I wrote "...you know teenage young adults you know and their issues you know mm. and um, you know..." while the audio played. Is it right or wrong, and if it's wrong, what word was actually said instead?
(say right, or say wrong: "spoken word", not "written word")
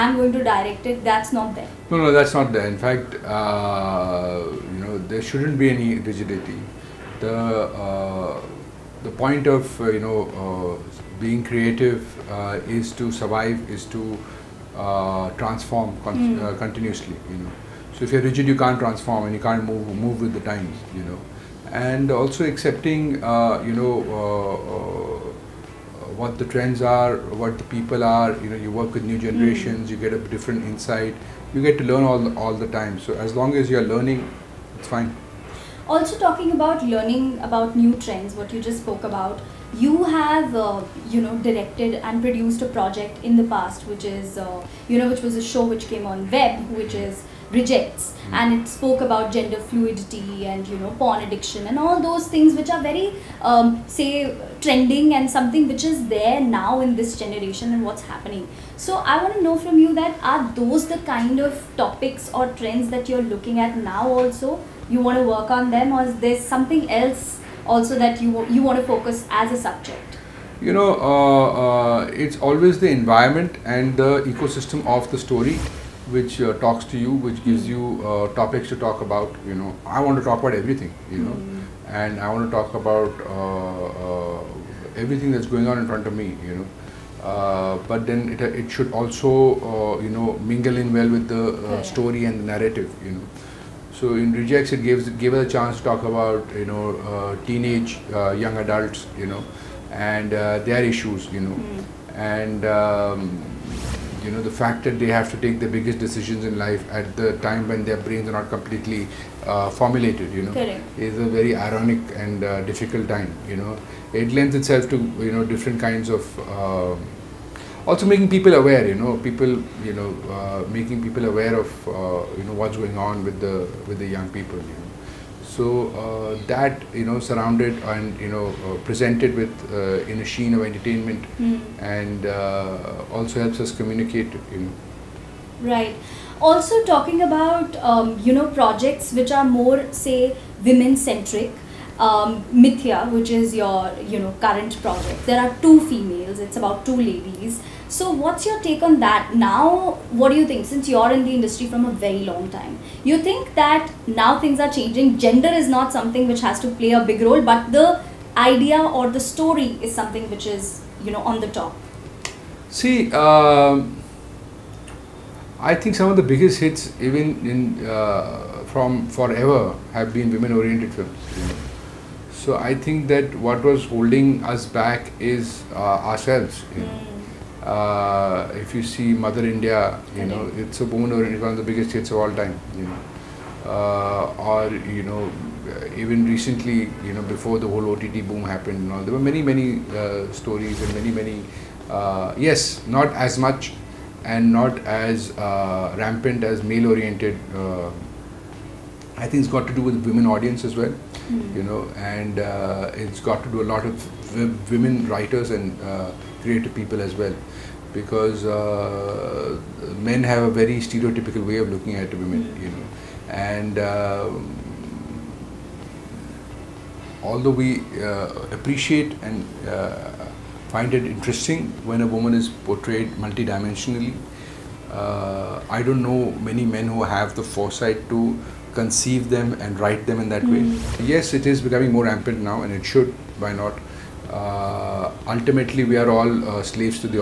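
right.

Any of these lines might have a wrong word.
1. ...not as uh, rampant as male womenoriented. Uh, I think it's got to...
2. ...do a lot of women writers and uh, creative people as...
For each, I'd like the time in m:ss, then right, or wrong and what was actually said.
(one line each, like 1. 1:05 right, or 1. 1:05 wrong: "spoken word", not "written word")
1. 3:14 wrong: "oriented", not "womenoriented"
2. 3:23 right.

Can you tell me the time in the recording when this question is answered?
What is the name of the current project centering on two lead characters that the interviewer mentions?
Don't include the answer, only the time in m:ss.
2:22.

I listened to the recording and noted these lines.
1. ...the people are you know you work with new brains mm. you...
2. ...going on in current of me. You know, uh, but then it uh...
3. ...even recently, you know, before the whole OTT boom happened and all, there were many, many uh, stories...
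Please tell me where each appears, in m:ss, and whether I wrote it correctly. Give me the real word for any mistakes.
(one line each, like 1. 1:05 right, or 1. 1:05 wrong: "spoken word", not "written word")
1. 0:27 wrong: "generations", not "brains"
2. 1:25 wrong: "front", not "current"
3. 3:05 right.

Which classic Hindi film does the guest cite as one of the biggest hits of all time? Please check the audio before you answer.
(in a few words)
Mother India.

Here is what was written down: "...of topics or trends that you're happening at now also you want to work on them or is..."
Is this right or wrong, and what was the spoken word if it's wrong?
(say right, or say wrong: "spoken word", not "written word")
wrong: "looking", not "happening".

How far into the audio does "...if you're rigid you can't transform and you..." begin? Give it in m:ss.
0:18.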